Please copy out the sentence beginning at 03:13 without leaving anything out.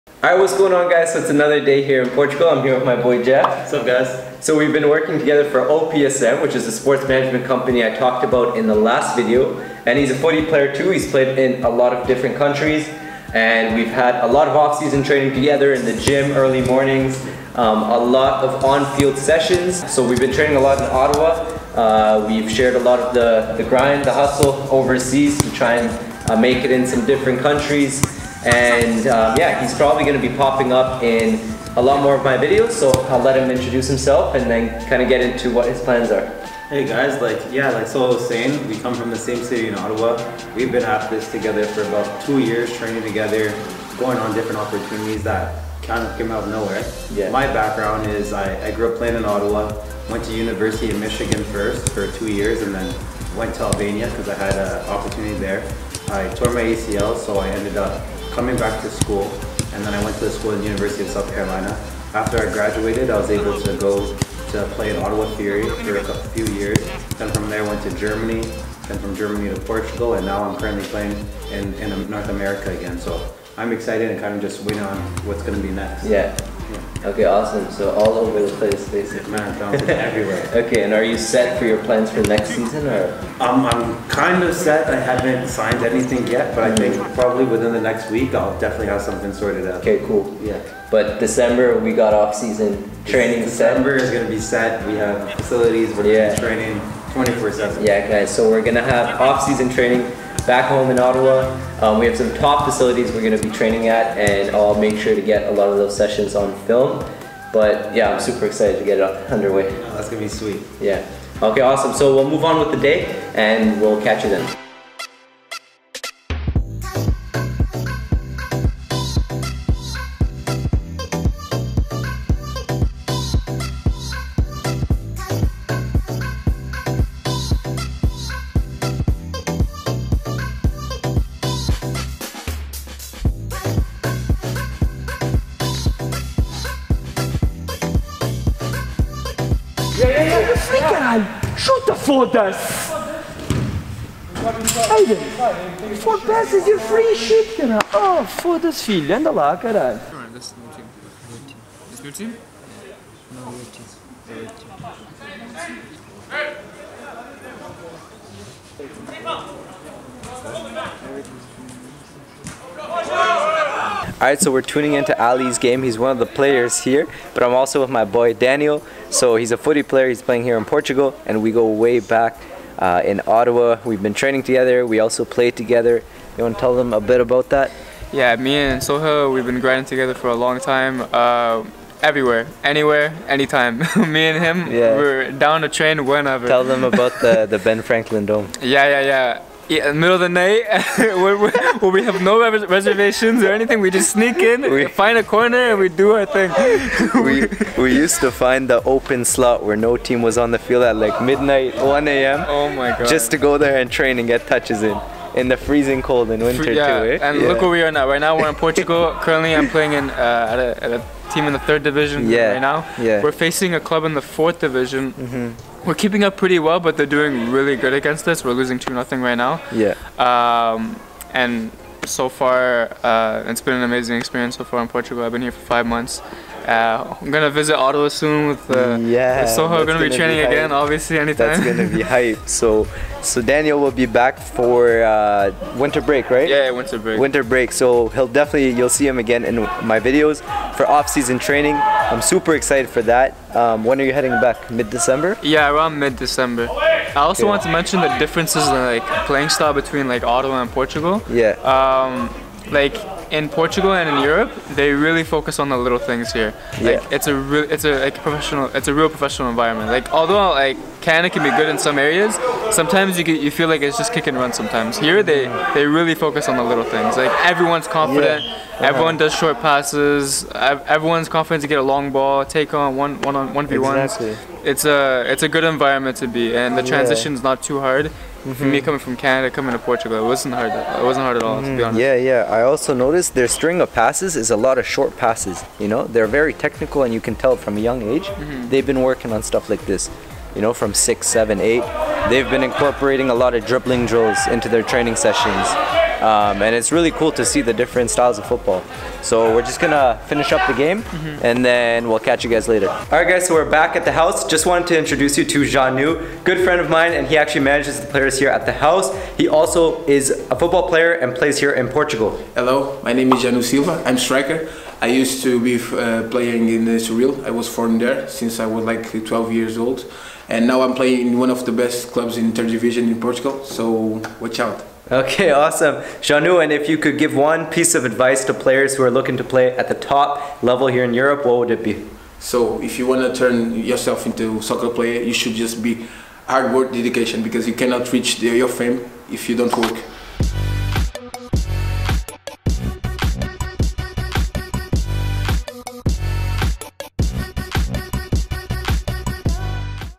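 We just sneak in, we, find a corner, and we do our thing.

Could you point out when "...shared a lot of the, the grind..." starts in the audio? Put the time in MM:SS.
00:22.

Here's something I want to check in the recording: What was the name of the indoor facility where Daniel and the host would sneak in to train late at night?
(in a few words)
Ben Franklin Dome.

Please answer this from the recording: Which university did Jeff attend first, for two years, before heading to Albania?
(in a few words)
University of Michigan.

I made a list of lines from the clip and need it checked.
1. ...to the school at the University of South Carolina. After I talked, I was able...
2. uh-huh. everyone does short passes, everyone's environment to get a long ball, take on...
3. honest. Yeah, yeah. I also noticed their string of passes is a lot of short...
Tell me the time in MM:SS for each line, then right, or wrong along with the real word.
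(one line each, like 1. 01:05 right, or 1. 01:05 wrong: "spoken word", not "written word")
1. 01:00 wrong: "graduated", not "talked"
2. 04:28 wrong: "confident", not "environment"
3. 04:42 right.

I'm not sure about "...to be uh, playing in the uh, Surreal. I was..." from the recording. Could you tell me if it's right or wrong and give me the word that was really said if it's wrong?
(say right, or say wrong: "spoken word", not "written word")
right.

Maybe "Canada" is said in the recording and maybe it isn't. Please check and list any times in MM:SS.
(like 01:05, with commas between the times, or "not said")
04:21, 04:39.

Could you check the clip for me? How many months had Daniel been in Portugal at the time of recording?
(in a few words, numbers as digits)
5.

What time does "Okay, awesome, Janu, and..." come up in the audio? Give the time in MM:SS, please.
05:25.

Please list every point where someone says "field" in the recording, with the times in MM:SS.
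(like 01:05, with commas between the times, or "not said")
00:18, 03:20.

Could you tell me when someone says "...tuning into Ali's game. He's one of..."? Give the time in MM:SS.
02:44.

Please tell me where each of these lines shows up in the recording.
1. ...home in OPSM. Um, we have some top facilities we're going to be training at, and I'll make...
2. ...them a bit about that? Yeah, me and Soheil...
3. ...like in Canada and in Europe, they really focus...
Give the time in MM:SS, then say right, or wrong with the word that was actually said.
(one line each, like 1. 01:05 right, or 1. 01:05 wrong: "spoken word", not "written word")
1. 01:40 wrong: "Ottawa", not "OPSM"
2. 02:56 right
3. 04:12 wrong: "Portugal", not "Canada".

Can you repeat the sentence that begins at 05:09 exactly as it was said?
He also is a football player and plays here in Portugal.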